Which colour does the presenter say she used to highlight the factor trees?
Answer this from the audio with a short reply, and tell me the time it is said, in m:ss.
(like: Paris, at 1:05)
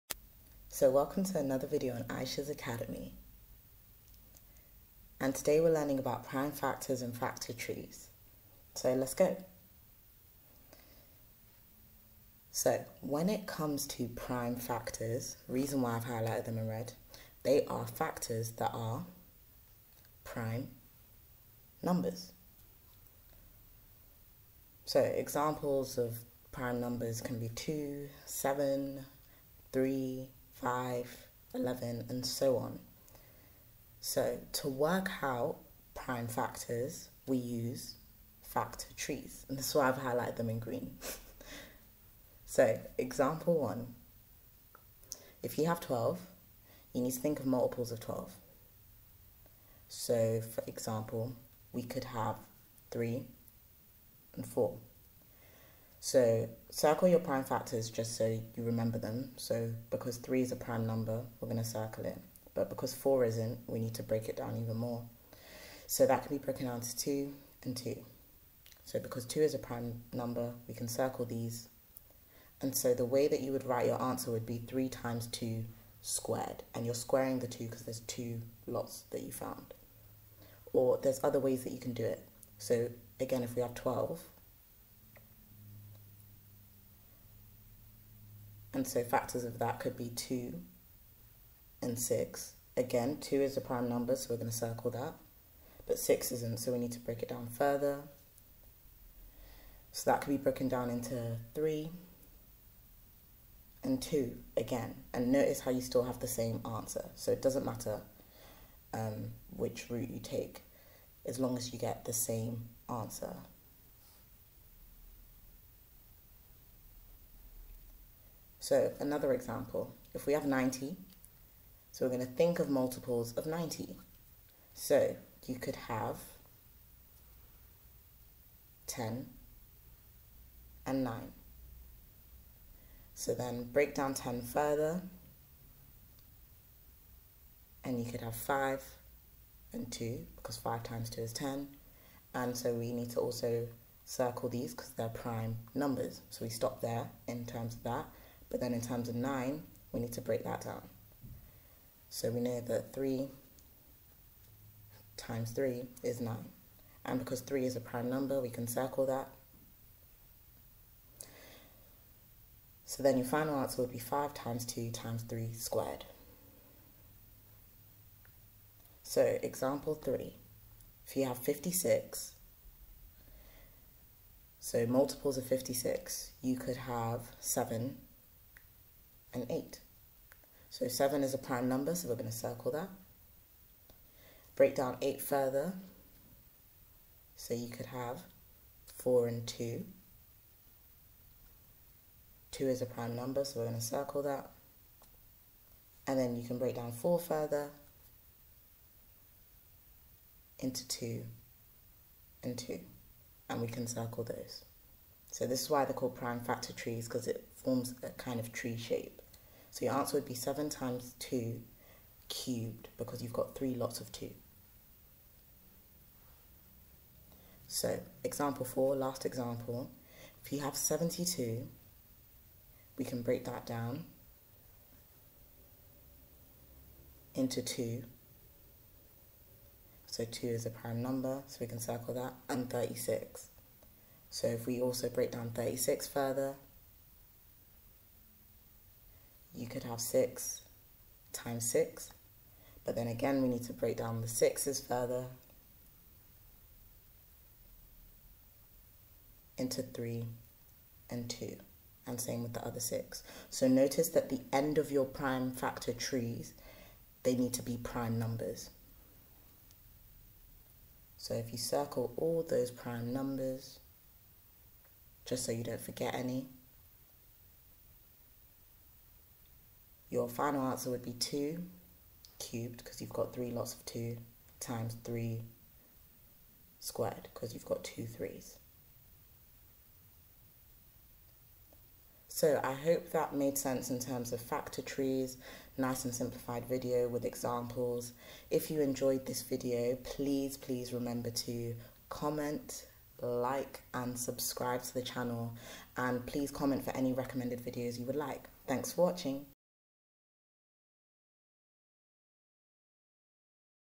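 green, at 0:40.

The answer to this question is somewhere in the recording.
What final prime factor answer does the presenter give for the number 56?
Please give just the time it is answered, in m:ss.
3:30.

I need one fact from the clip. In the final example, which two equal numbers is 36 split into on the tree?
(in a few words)
6 times 6.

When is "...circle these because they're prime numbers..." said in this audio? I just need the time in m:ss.
2:24.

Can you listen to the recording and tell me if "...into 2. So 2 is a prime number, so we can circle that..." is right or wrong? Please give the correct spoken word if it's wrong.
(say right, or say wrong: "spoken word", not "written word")
right.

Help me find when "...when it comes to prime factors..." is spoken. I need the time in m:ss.
0:13.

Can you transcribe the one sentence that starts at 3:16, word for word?
And then you can break down 4 further into 2 and 2.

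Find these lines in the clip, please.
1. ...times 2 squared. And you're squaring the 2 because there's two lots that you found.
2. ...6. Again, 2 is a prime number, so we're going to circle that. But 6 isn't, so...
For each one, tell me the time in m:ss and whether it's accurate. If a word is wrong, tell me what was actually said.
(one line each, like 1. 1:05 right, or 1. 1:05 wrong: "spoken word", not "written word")
1. 1:14 right
2. 1:31 right.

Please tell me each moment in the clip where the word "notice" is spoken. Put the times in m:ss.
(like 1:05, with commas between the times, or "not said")
1:45, 4:13.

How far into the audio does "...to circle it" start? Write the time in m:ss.
1:01.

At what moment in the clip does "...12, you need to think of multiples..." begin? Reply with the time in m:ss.
0:45.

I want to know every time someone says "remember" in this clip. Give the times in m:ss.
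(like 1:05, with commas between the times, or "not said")
0:58, 4:50.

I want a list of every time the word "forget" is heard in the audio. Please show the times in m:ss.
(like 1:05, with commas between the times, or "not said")
4:25.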